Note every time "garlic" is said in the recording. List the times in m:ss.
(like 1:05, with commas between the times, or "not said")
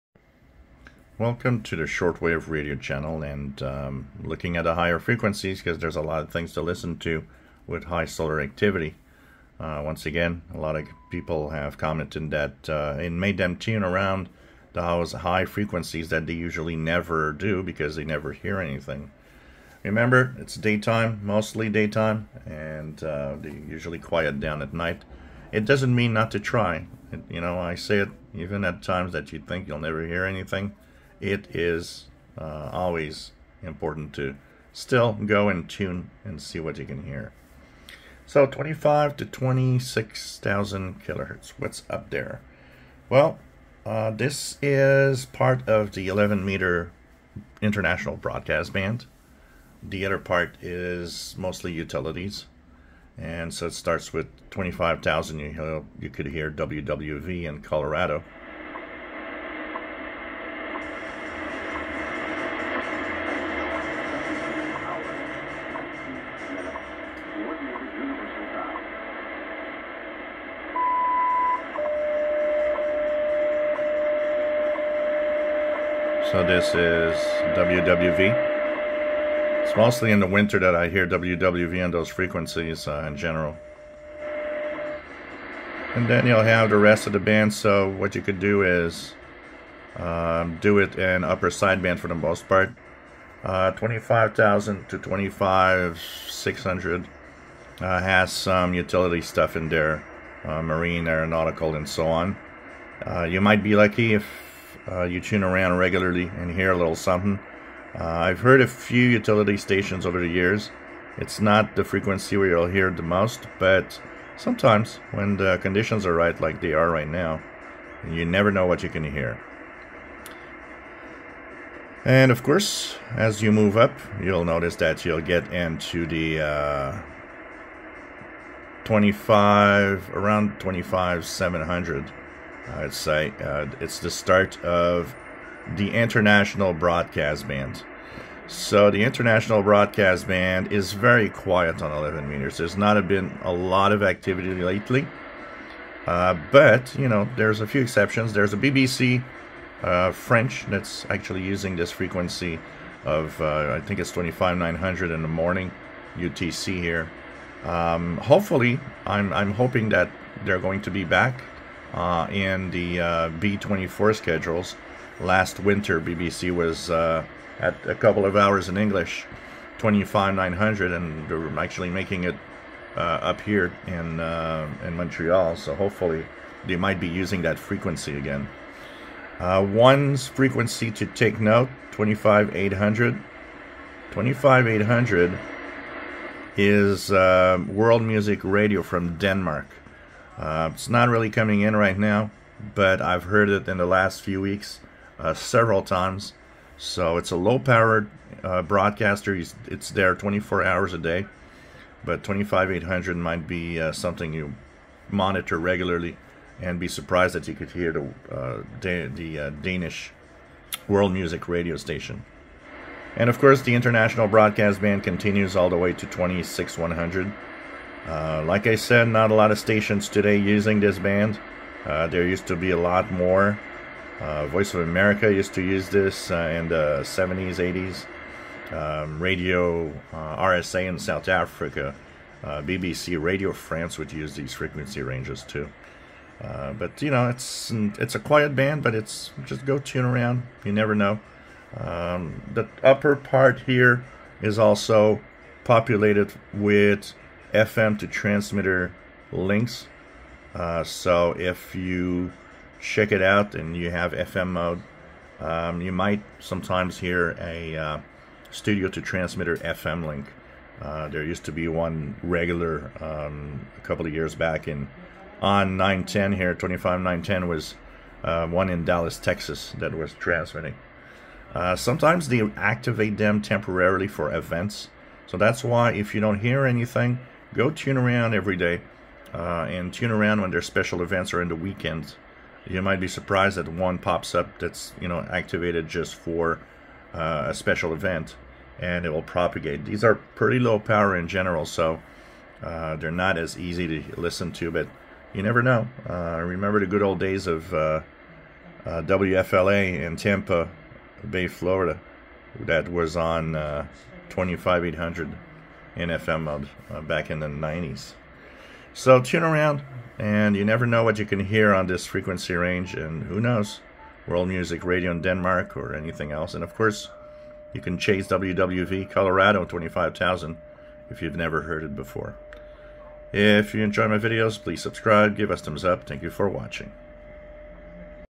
not said.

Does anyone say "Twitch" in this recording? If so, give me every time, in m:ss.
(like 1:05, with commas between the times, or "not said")
not said.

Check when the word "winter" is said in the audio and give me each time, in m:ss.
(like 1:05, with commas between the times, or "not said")
1:20, 2:45.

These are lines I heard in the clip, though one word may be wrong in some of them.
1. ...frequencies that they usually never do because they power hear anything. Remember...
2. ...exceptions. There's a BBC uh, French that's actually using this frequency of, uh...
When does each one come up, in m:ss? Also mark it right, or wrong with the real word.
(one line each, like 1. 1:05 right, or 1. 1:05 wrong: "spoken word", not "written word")
1. 0:15 wrong: "never", not "power"
2. 2:27 right.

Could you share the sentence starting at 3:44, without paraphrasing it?
Uh, Voice of America used to use this uh, in the 70s, 80s.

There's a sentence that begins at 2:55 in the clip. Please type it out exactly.
So hopefully they might be using that frequency again.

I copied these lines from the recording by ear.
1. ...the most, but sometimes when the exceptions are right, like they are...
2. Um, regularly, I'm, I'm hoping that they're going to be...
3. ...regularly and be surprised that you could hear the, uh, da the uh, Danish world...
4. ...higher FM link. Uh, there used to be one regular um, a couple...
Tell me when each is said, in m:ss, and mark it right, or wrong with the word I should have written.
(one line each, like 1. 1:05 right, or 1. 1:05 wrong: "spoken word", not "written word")
1. 1:52 wrong: "conditions", not "exceptions"
2. 2:37 wrong: "hopefully", not "regularly"
3. 3:25 right
4. 4:19 wrong: "transmitter", not "higher".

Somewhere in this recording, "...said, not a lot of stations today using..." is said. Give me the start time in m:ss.
3:38.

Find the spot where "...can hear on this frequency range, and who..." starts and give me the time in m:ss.
5:11.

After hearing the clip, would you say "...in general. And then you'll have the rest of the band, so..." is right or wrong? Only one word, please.
right.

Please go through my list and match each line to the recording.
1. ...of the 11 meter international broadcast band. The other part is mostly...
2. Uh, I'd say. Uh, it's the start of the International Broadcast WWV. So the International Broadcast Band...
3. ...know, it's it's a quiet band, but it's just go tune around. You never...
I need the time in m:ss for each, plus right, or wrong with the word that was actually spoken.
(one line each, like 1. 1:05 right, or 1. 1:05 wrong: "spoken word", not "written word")
1. 0:45 right
2. 2:12 wrong: "Band", not "WWV"
3. 3:57 right.